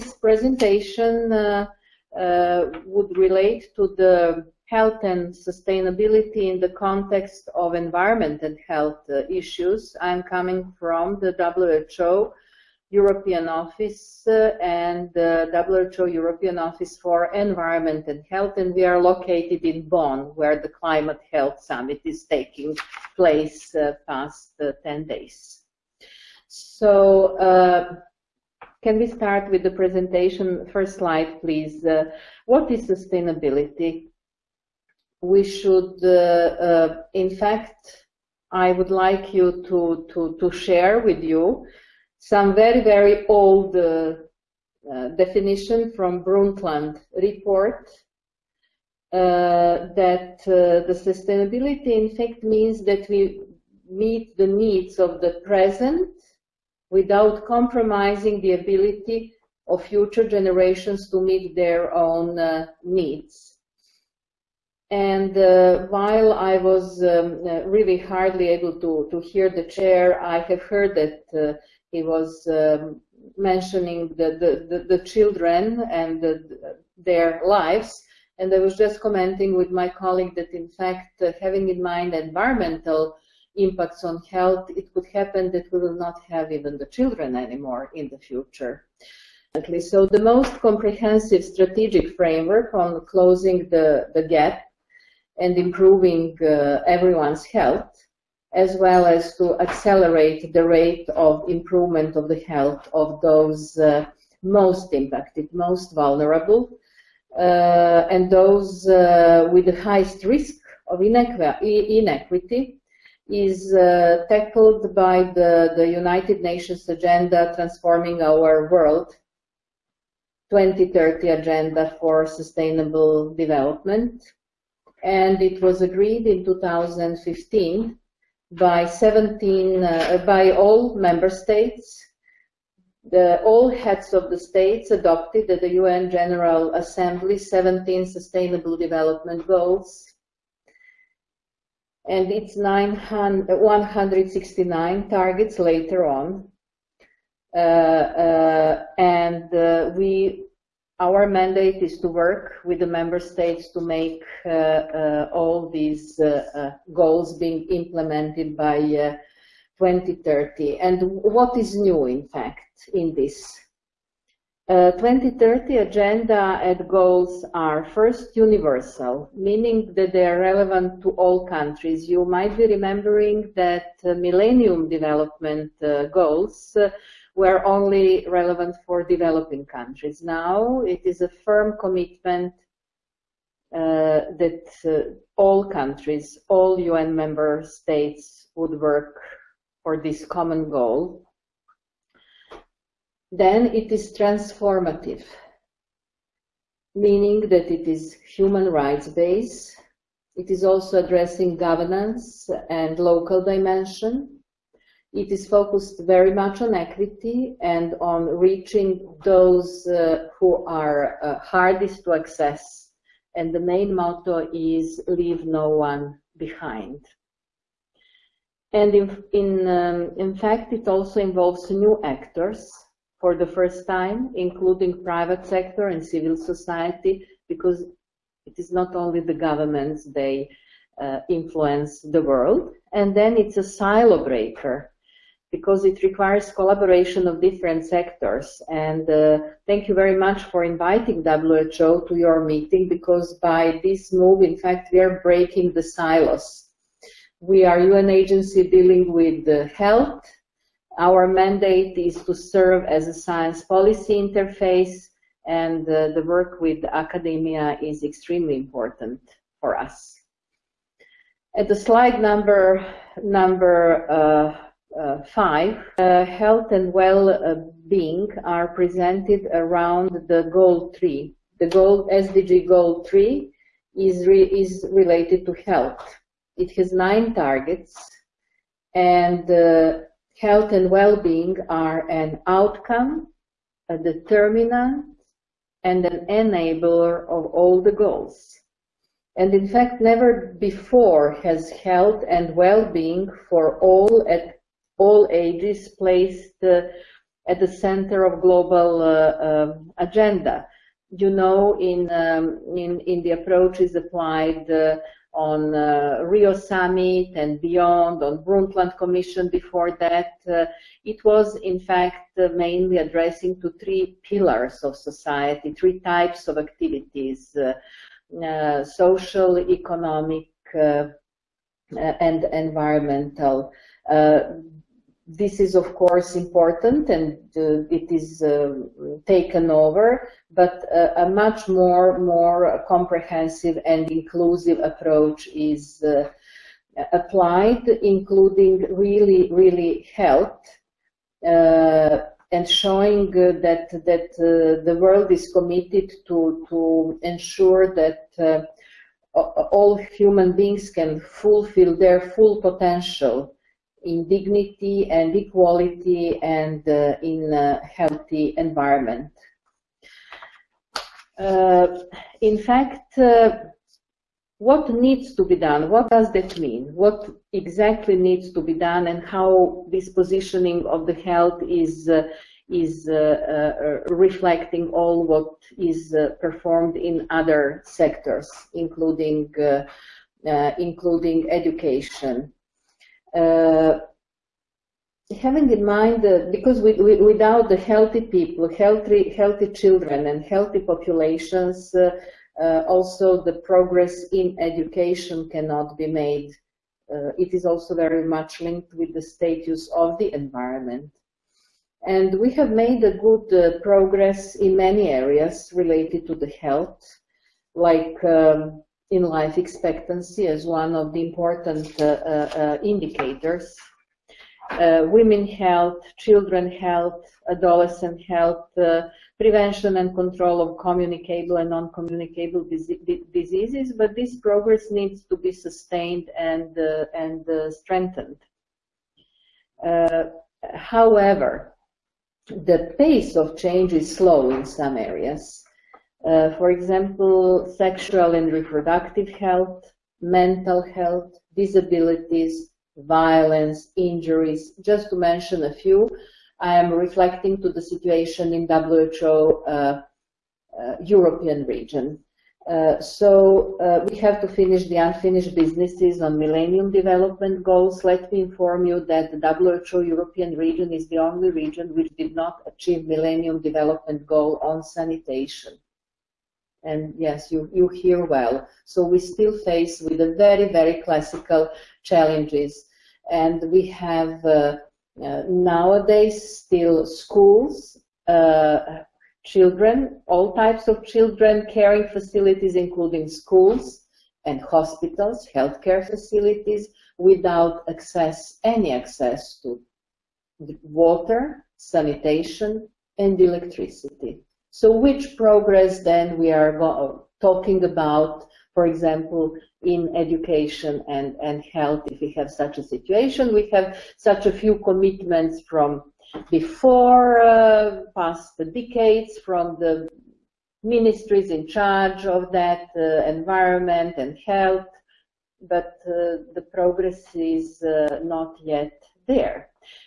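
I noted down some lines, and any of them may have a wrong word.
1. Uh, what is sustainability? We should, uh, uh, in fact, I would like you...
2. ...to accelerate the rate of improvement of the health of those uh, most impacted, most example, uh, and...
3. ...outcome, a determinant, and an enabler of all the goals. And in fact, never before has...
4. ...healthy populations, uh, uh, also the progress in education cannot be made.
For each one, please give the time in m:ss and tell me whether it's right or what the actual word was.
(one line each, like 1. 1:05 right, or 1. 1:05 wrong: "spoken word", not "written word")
1. 0:31 right
2. 1:39 wrong: "vulnerable", not "example"
3. 4:42 right
4. 6:30 right.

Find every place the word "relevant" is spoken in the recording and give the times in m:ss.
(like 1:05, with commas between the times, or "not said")
2:50, 2:58.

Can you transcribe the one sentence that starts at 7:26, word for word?
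I am reflecting to the situation in WHO uh, uh, European region.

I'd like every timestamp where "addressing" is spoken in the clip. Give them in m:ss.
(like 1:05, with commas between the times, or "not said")
3:21, 5:12.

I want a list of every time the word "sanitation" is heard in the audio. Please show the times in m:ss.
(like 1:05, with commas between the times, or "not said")
7:44, 8:11.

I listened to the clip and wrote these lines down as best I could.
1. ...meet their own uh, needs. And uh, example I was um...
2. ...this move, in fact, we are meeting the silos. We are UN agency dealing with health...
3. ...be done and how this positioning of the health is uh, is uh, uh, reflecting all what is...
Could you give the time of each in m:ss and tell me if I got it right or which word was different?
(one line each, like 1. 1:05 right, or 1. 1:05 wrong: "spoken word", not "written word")
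1. 1:01 wrong: "while", not "example"
2. 4:03 wrong: "breaking", not "meeting"
3. 6:08 right.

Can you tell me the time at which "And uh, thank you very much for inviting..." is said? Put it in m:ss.
3:58.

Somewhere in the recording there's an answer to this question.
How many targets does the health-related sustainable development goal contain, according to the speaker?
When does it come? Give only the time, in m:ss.
4:36.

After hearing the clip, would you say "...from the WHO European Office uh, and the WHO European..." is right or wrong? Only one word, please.
right.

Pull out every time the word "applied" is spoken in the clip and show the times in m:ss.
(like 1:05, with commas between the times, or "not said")
5:03, 5:37.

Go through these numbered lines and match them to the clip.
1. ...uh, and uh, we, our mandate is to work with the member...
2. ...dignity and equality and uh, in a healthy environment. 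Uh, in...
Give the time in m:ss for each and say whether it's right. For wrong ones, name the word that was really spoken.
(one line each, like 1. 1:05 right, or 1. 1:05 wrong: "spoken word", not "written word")
1. 2:27 right
2. 5:54 right.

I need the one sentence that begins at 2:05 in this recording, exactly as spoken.
And it was agreed in 2015 by 17, uh, by all member states.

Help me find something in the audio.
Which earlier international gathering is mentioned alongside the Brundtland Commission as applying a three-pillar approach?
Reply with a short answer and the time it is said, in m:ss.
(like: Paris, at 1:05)
Rio Summit, at 5:06.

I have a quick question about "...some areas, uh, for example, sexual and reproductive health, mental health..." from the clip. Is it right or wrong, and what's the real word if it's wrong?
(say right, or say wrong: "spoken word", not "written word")
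right.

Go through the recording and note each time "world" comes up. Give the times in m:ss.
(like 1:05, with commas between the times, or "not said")
1:58, 3:52, 5:44.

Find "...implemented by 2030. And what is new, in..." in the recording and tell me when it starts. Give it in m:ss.
2:37.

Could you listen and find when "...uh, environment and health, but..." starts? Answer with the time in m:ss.
8:32.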